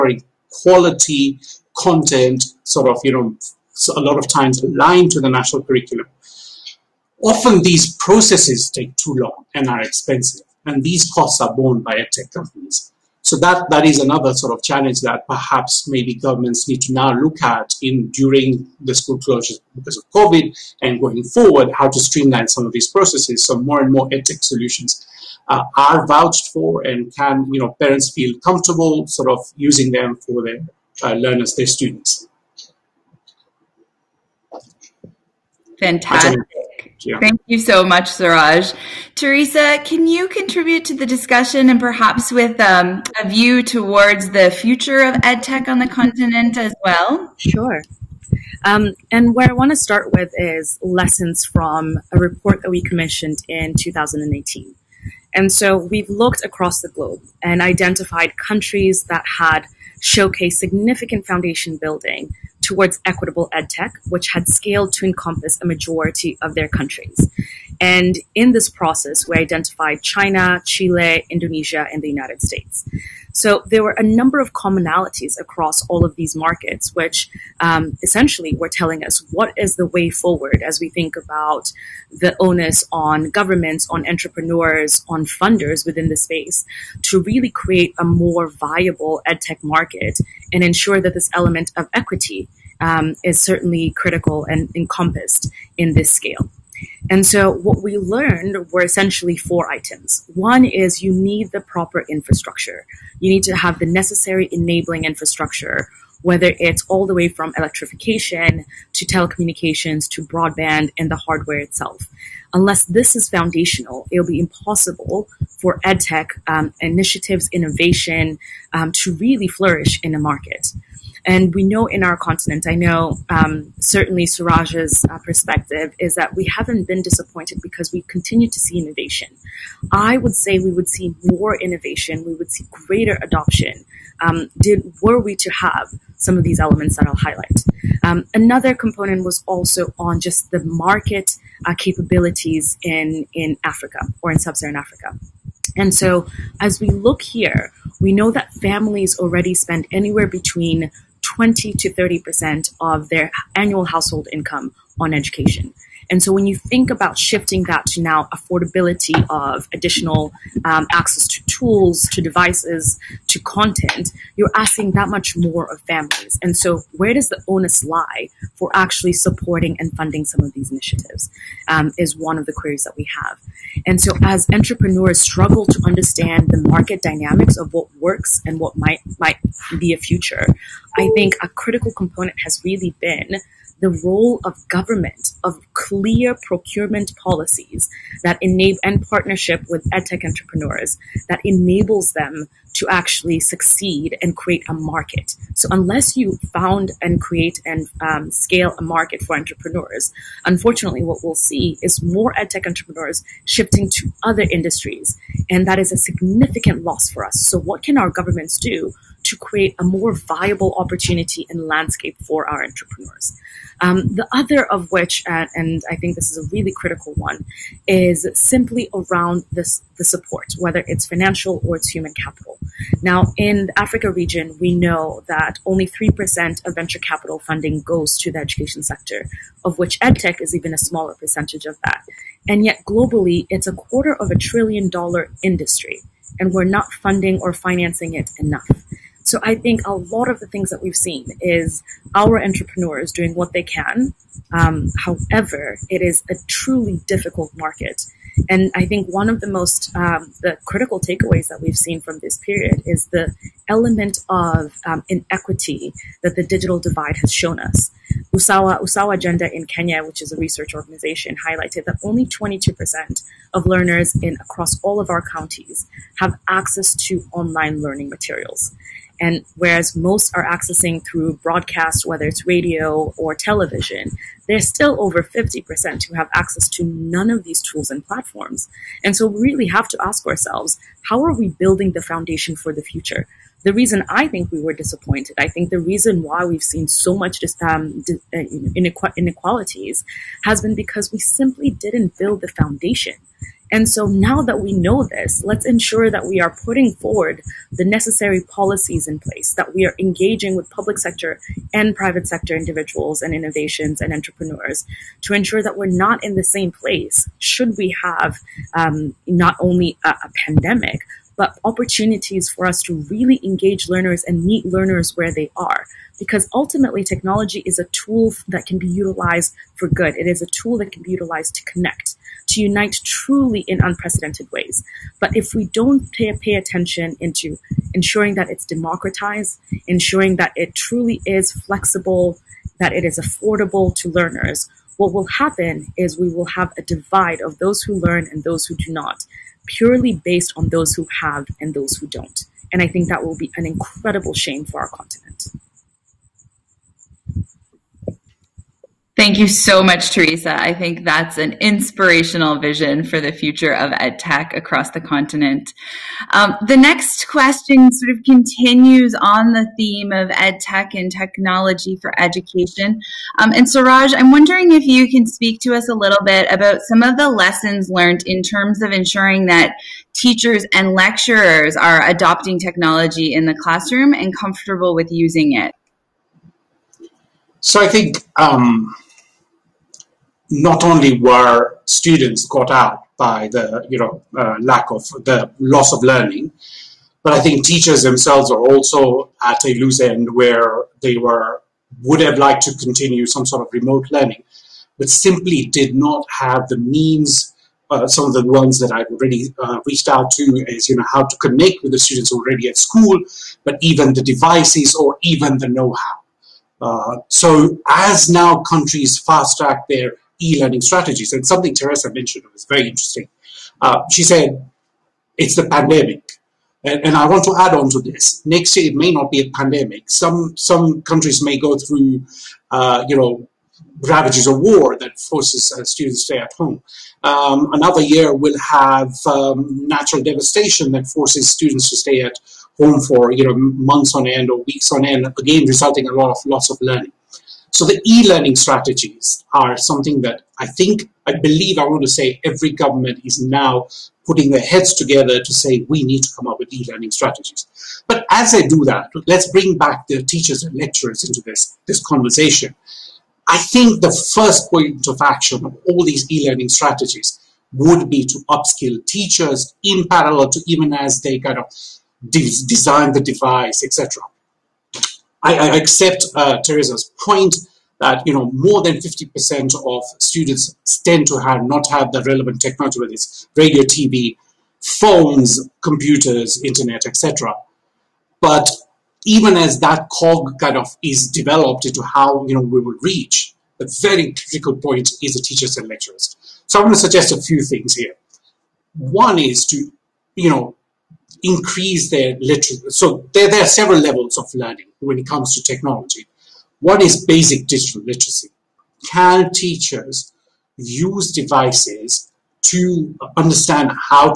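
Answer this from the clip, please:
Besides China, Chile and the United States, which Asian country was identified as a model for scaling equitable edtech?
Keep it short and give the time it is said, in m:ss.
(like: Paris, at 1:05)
Indonesia, at 1:11.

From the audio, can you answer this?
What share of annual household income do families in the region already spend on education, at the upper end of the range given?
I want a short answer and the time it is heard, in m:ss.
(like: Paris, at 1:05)
30%, at 2:31.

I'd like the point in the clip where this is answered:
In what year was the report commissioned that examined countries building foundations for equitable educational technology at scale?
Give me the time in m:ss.
0:53.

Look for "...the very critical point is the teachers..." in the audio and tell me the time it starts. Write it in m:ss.
8:03.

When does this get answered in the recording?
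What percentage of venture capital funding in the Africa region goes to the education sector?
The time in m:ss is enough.
3:45.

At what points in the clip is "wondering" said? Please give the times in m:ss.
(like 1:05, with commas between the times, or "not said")
6:04.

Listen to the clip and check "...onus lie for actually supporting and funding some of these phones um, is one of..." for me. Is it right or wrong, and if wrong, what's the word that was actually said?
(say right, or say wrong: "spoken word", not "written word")
wrong: "initiatives", not "phones".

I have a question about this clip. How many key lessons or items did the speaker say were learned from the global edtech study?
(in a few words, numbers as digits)
4.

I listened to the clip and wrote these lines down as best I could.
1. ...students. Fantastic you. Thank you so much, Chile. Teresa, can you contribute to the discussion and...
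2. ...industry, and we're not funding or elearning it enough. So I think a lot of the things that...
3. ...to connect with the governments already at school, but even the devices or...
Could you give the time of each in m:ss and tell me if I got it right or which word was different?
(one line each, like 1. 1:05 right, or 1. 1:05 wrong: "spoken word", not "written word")
1. 0:31 wrong: "Siraj", not "Chile"
2. 3:55 wrong: "financing", not "elearning"
3. 6:41 wrong: "students", not "governments".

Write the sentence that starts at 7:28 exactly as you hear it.
But as they do that, let's bring back the teachers and lecturers into this, this conversation.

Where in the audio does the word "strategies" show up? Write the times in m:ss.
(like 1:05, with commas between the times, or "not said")
6:50, 7:18, 7:27, 7:36.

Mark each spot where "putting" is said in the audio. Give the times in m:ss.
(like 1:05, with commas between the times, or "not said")
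4:56, 7:24.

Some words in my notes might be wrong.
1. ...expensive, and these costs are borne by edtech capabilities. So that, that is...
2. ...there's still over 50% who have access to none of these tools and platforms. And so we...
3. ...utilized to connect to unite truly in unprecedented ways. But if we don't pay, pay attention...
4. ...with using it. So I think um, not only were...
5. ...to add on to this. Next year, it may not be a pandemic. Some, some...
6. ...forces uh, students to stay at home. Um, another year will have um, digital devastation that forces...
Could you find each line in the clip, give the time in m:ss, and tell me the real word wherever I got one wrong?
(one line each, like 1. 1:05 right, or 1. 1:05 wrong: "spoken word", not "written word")
1. 0:09 wrong: "companies", not "capabilities"
2. 4:34 right
3. 5:21 right
4. 6:14 right
5. 6:57 right
6. 7:05 wrong: "natural", not "digital".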